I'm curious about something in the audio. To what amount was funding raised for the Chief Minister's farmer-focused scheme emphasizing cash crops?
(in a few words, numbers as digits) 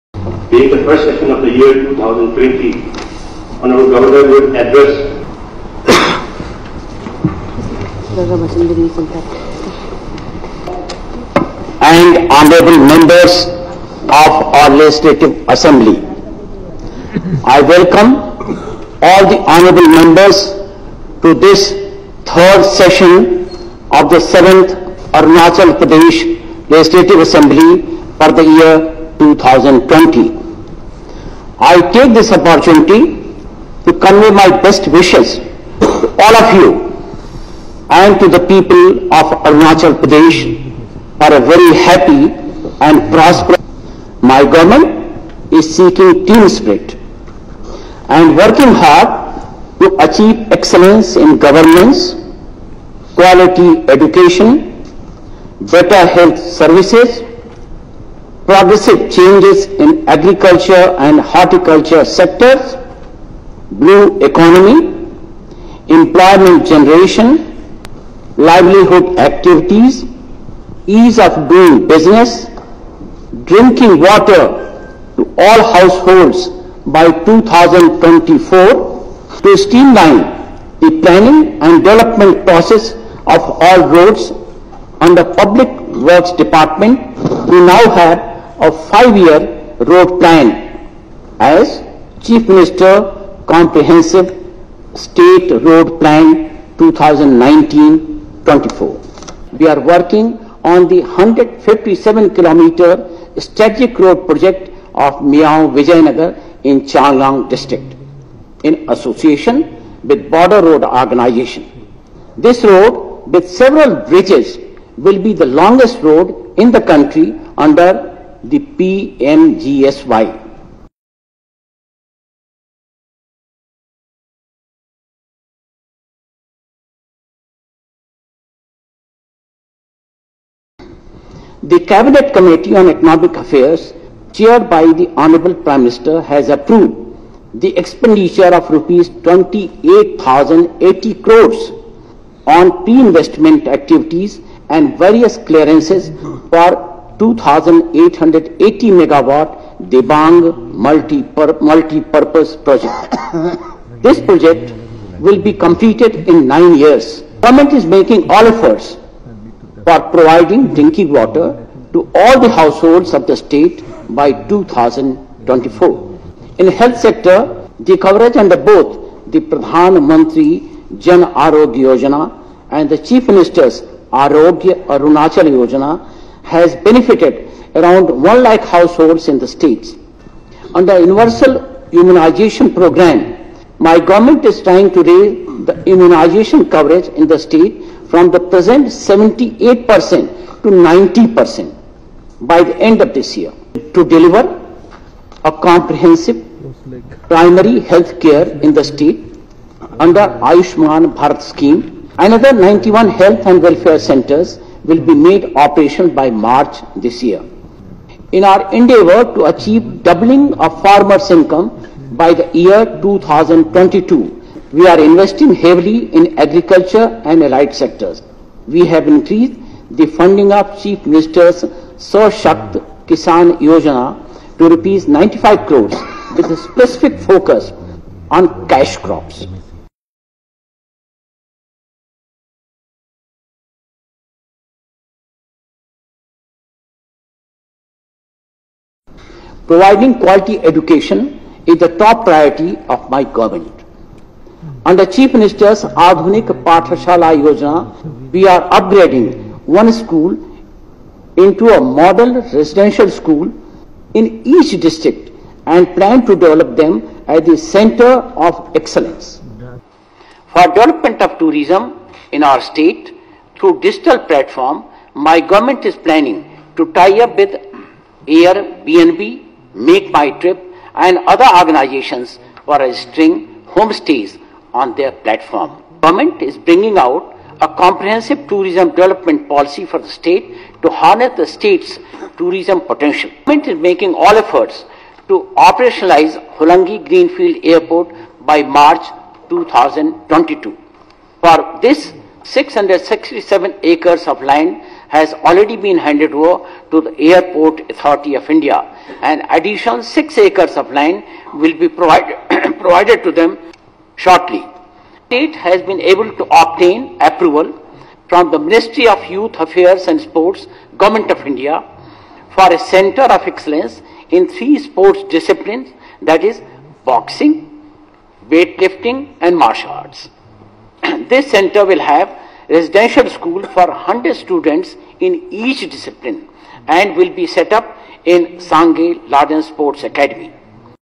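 95 crores.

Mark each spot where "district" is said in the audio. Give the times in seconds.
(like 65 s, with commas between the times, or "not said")
107 s, 254 s.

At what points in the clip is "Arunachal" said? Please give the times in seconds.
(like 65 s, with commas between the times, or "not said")
25 s, 39 s, 174 s.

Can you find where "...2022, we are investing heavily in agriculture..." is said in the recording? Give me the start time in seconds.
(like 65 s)
213 s.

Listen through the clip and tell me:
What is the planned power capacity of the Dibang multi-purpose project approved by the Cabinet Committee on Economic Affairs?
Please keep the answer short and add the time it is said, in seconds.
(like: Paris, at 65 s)
2,880 megawatt, at 147 s.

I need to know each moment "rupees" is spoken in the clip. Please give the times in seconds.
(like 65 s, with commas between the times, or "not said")
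138 s, 224 s.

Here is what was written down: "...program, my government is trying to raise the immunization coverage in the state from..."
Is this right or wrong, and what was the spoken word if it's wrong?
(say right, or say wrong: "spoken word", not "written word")
right.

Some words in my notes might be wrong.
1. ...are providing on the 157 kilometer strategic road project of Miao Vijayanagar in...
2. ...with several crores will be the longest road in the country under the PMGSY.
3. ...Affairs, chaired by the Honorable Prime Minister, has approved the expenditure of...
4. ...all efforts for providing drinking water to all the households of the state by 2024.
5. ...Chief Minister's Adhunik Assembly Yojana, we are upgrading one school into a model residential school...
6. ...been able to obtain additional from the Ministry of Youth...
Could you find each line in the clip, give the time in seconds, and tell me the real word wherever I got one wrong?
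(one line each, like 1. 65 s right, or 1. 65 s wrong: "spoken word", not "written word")
1. 99 s wrong: "working", not "providing"
2. 113 s wrong: "bridges", not "crores"
3. 133 s right
4. 158 s right
5. 245 s wrong: "Pathashala", not "Assembly"
6. 305 s wrong: "approval", not "additional".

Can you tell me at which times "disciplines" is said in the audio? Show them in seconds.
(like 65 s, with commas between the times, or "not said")
315 s, 325 s.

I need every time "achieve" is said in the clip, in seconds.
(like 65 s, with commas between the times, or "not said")
50 s, 209 s.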